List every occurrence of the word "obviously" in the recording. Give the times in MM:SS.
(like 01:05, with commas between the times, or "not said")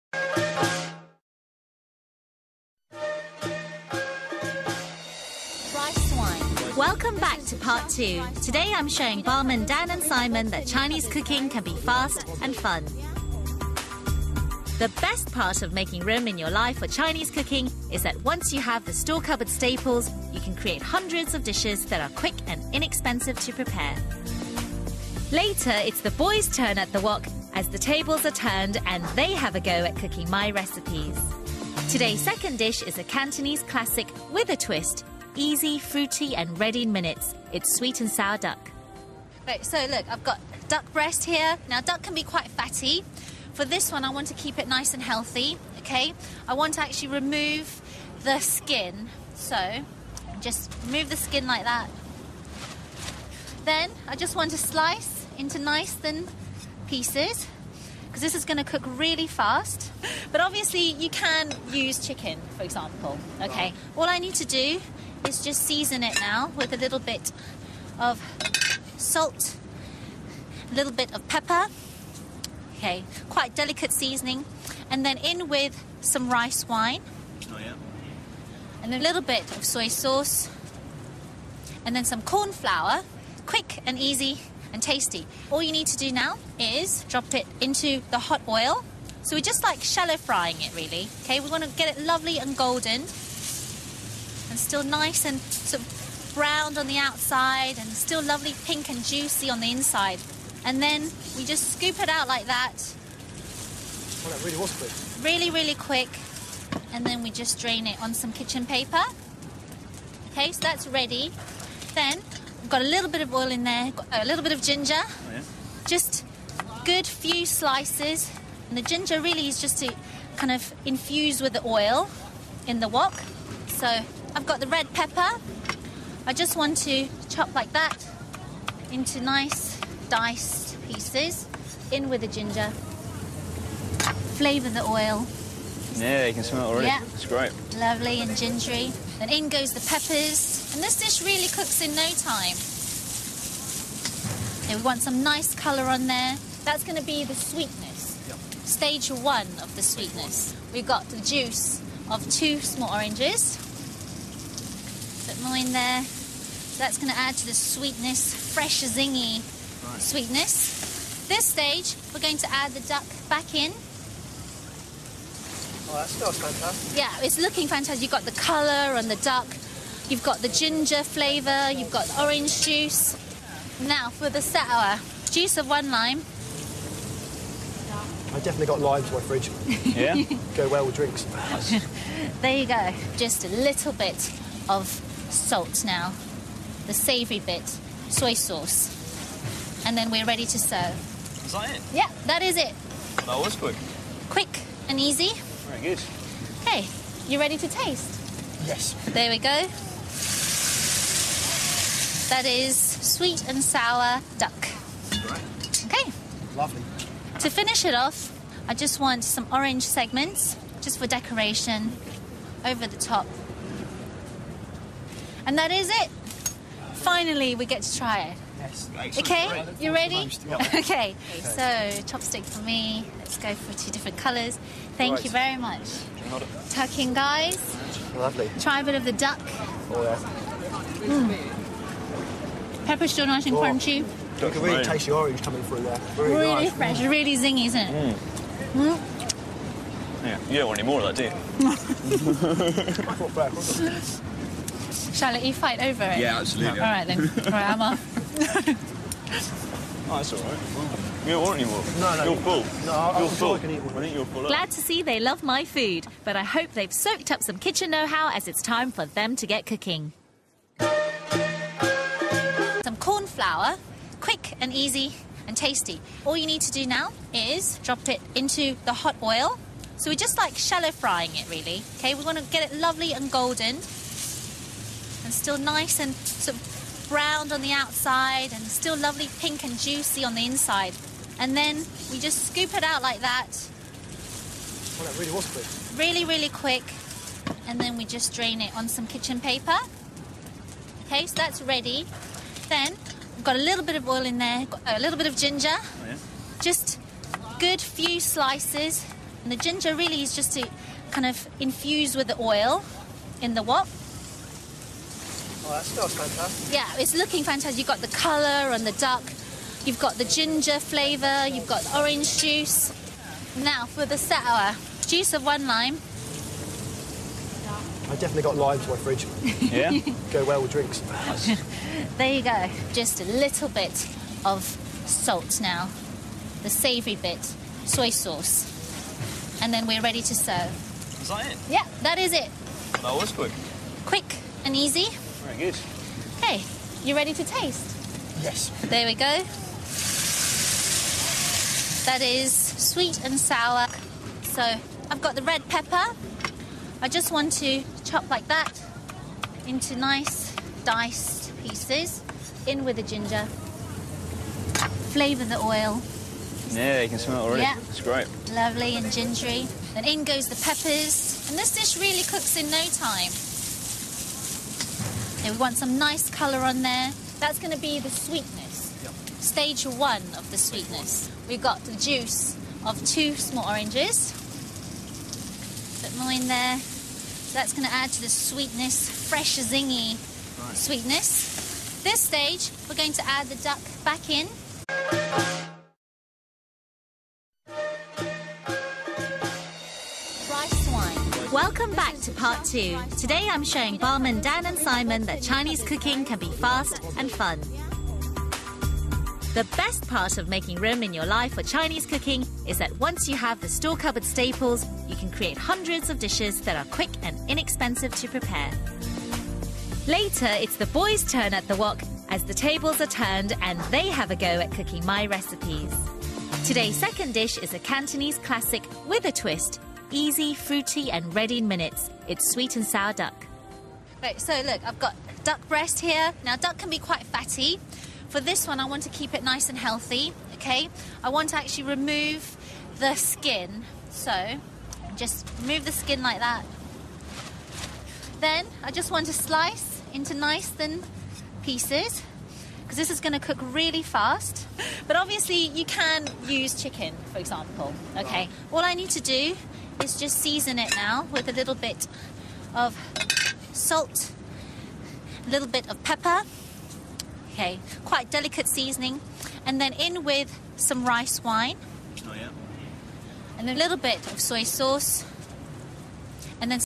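01:00, 07:25.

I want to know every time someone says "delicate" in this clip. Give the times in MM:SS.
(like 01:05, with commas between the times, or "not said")
01:13, 07:38.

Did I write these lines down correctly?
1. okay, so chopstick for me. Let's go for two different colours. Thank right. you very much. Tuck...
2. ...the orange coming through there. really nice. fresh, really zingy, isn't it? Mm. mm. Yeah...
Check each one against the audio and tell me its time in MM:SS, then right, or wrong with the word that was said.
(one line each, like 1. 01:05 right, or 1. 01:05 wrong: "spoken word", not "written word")
1. 03:40 right
2. 03:55 right.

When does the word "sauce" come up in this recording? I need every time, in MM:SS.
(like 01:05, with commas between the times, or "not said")
01:19, 03:08, 05:28, 07:44.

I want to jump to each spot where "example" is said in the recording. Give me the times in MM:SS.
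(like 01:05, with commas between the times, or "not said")
01:02, 07:27.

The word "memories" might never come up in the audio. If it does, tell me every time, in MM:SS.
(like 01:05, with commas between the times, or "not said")
not said.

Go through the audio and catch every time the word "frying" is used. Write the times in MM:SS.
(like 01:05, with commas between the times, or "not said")
01:30, 04:30.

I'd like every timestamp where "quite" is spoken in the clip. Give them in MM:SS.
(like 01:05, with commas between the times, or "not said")
00:42, 01:13, 07:06, 07:38.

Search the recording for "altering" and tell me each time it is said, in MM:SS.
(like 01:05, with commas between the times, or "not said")
not said.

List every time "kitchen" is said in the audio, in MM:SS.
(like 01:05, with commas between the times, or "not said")
01:48, 04:17, 04:49.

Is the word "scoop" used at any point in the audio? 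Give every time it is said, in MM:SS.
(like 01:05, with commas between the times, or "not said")
01:41, 04:42.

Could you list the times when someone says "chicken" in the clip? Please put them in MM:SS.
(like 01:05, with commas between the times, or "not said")
01:02, 07:26.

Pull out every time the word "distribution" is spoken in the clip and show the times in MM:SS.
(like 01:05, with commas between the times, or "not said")
not said.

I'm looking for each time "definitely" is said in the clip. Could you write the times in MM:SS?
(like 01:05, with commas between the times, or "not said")
02:58, 05:18.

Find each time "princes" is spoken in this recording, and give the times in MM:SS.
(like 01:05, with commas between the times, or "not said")
not said.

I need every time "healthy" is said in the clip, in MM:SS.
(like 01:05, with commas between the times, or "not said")
00:45, 07:09.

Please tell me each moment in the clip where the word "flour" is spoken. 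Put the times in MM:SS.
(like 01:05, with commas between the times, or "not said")
01:22, 04:23.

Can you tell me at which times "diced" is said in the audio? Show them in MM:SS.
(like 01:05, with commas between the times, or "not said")
02:10, 05:50.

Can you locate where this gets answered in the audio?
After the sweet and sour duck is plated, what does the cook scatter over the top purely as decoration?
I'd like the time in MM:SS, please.
03:29.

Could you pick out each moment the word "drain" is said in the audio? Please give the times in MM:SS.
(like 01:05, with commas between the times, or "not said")
01:47, 04:48.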